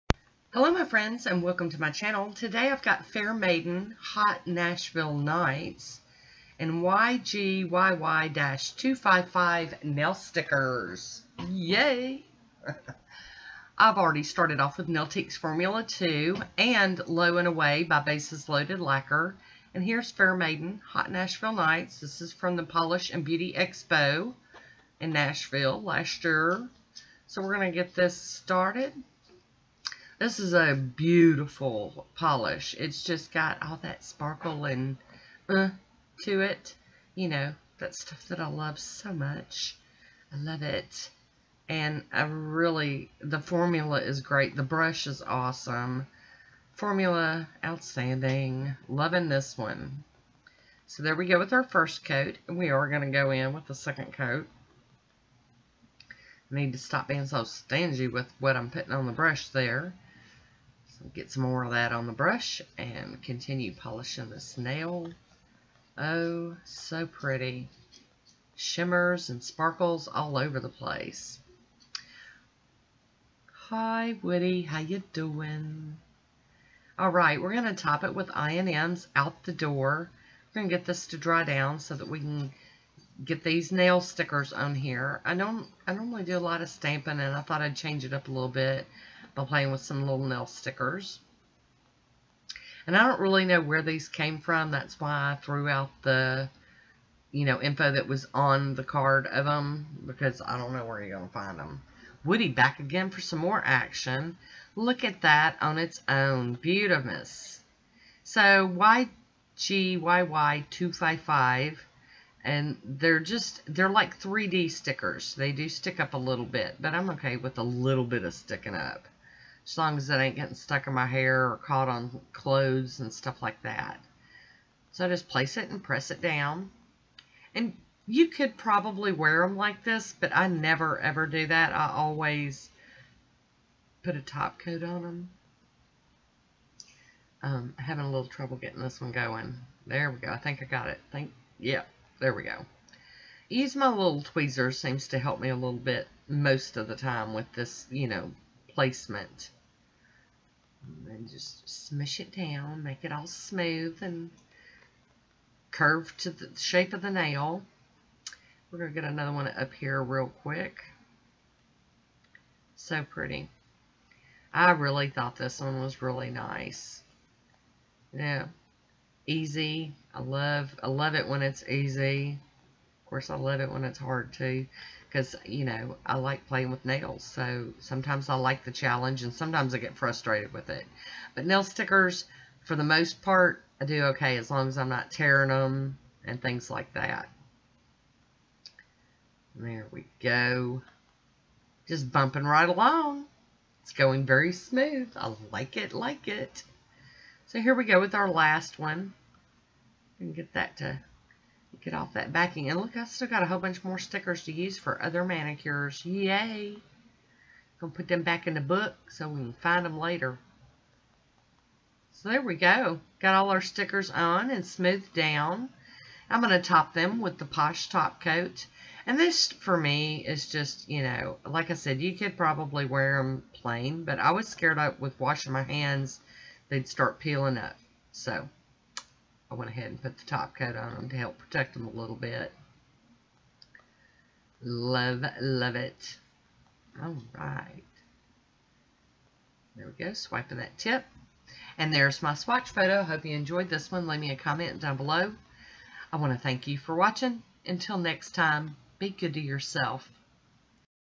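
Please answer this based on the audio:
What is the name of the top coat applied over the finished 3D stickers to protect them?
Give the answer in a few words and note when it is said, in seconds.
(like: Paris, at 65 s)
Posh Top Coat, at 217 s.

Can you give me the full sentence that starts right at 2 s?
Today I've got Fair Maiden Hot Nashville Nights and YGYY-255 nail stickers.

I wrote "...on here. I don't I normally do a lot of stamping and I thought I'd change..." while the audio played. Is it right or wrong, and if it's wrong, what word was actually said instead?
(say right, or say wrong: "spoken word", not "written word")
right.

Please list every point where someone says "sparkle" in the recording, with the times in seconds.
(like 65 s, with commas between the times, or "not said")
34 s, 69 s.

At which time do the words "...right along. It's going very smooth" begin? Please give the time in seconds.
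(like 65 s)
192 s.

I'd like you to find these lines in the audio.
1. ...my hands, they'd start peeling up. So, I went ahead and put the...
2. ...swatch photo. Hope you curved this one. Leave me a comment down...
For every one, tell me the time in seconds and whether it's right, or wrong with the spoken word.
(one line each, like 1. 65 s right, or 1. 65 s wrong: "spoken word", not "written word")
1. 225 s right
2. 242 s wrong: "enjoyed", not "curved".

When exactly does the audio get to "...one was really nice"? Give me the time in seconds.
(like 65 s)
165 s.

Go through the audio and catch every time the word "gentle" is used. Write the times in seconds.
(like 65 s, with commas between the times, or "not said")
not said.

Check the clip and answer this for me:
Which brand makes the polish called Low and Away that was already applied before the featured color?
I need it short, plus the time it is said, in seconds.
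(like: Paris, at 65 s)
Bases Loaded Lacquer, at 18 s.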